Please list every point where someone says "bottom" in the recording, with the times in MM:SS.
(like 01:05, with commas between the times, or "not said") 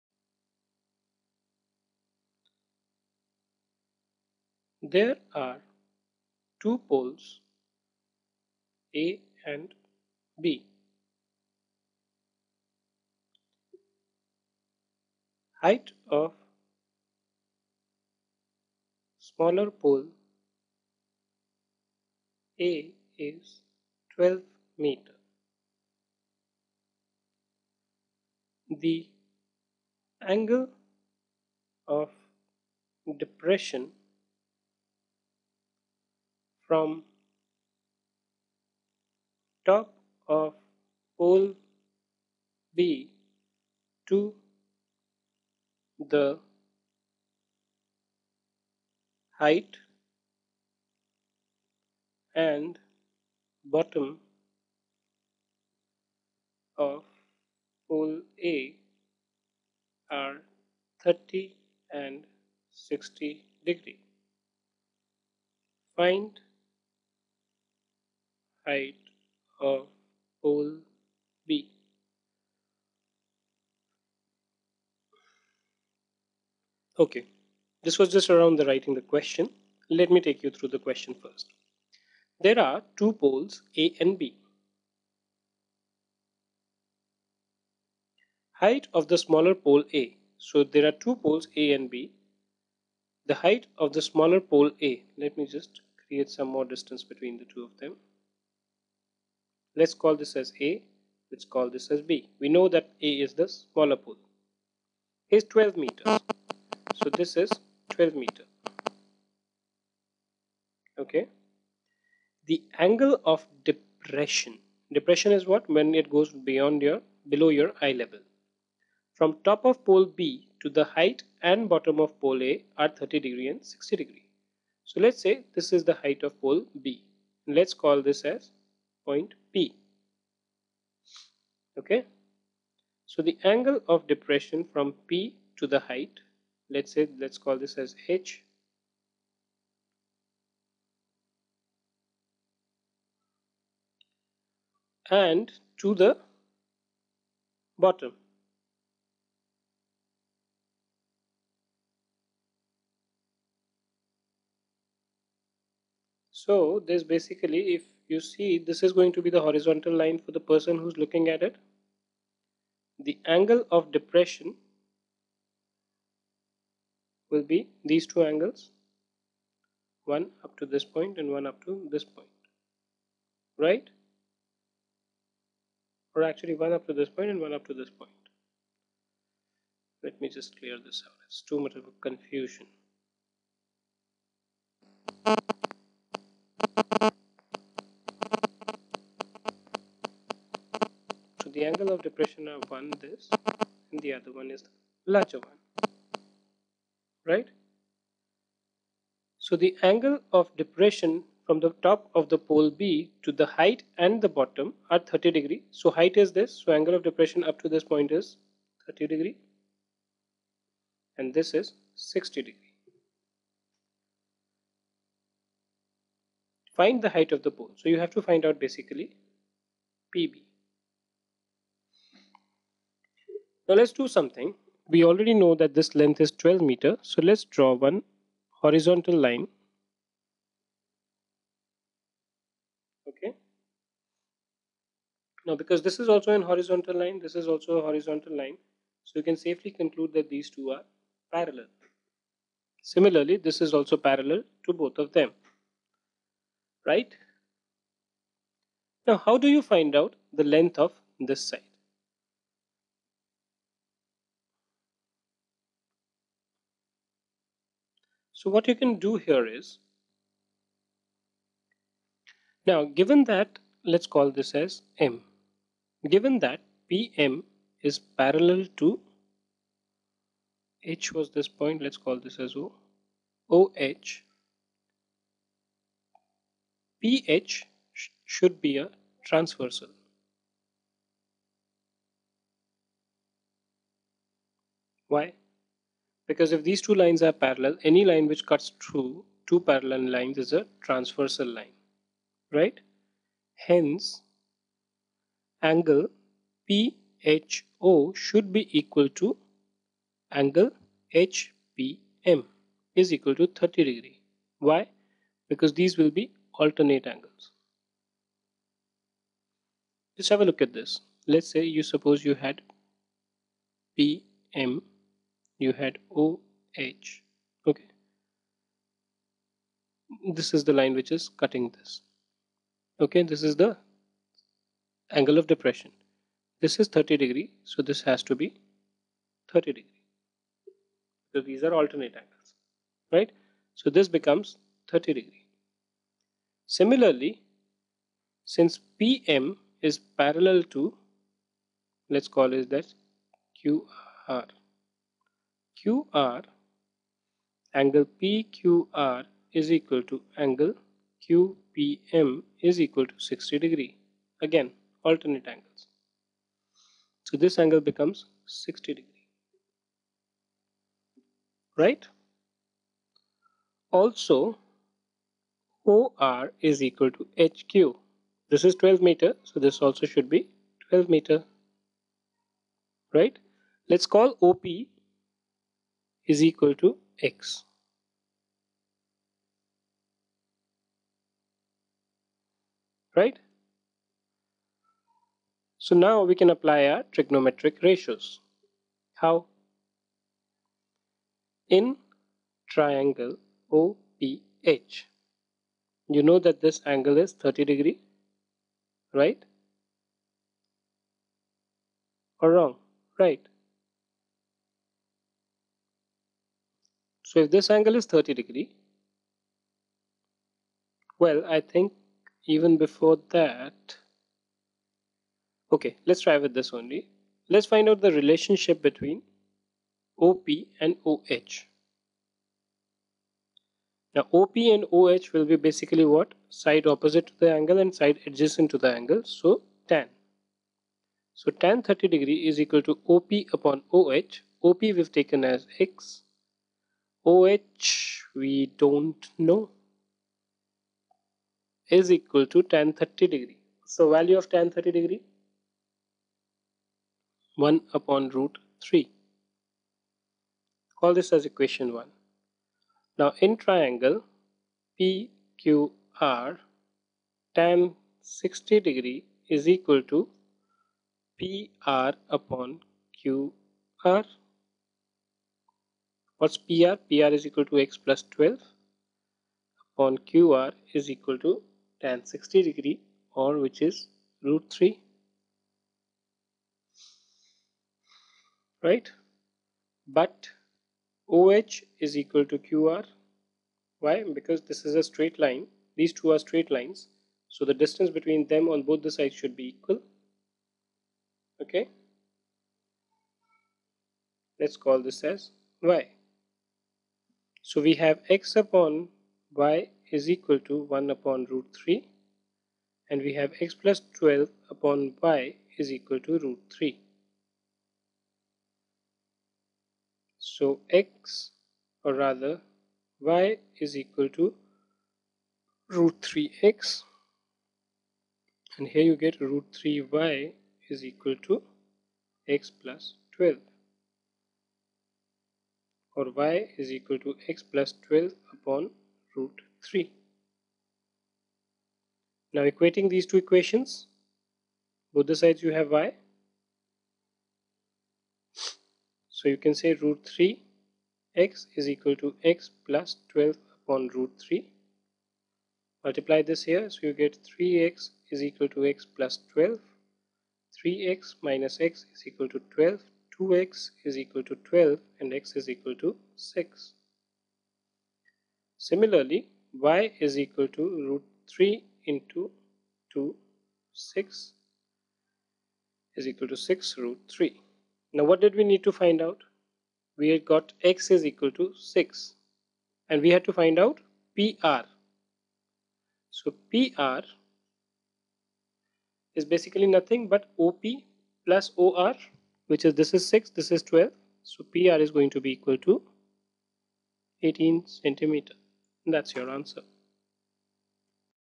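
00:53, 02:01, 02:27, 03:24.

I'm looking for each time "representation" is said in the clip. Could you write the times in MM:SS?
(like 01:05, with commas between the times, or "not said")
not said.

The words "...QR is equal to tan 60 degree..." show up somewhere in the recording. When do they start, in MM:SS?
07:50.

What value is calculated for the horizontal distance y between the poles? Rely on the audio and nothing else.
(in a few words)
6√3.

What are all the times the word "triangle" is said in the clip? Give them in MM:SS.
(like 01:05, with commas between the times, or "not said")
06:32, 07:33.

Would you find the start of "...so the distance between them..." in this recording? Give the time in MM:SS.
08:07.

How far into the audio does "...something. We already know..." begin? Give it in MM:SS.
03:44.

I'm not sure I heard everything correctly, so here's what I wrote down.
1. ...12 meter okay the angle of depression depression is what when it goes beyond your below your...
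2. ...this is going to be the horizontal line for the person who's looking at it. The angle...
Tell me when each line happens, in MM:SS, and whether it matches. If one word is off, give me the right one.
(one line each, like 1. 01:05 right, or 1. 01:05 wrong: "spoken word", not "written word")
1. 01:47 right
2. 02:38 right.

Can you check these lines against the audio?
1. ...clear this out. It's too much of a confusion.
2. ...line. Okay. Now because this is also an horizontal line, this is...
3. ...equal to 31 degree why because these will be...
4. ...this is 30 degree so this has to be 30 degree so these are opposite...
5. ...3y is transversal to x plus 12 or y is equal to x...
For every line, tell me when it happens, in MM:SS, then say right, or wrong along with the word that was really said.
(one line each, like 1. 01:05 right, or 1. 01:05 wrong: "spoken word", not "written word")
1. 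03:00 right
2. 03:49 right
3. 05:03 wrong: "30", not "31"
4. 05:26 wrong: "alternate", not "opposite"
5. 08:39 wrong: "equal", not "transversal".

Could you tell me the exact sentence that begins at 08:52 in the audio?
Now equating these two equations, both the sides you have y.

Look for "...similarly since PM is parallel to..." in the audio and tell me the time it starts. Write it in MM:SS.
05:36.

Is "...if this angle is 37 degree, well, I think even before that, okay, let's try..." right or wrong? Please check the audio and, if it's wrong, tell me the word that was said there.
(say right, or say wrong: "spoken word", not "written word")
wrong: "30", not "37".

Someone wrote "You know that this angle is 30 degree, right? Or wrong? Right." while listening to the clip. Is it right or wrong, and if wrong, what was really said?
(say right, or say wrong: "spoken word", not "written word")
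right.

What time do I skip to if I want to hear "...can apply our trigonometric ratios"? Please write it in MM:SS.
06:26.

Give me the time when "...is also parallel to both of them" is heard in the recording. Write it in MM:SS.
04:03.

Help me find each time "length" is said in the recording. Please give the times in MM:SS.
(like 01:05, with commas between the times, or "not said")
03:45, 04:10.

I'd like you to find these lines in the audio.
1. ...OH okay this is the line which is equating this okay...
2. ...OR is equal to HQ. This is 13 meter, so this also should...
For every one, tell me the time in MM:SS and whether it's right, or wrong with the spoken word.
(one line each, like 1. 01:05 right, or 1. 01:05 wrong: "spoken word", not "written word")
1. 05:16 wrong: "cutting", not "equating"
2. 06:05 wrong: "12", not "13".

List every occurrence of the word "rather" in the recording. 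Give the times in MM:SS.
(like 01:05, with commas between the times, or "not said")
08:32.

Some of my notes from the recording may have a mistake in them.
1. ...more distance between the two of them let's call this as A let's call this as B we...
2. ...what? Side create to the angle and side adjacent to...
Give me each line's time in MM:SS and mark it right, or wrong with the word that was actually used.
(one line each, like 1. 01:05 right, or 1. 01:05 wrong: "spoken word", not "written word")
1. 01:36 right
2. 07:06 wrong: "opposite", not "create".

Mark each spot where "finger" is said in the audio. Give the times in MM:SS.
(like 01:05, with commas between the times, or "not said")
not said.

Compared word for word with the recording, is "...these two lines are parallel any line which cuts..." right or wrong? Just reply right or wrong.
right.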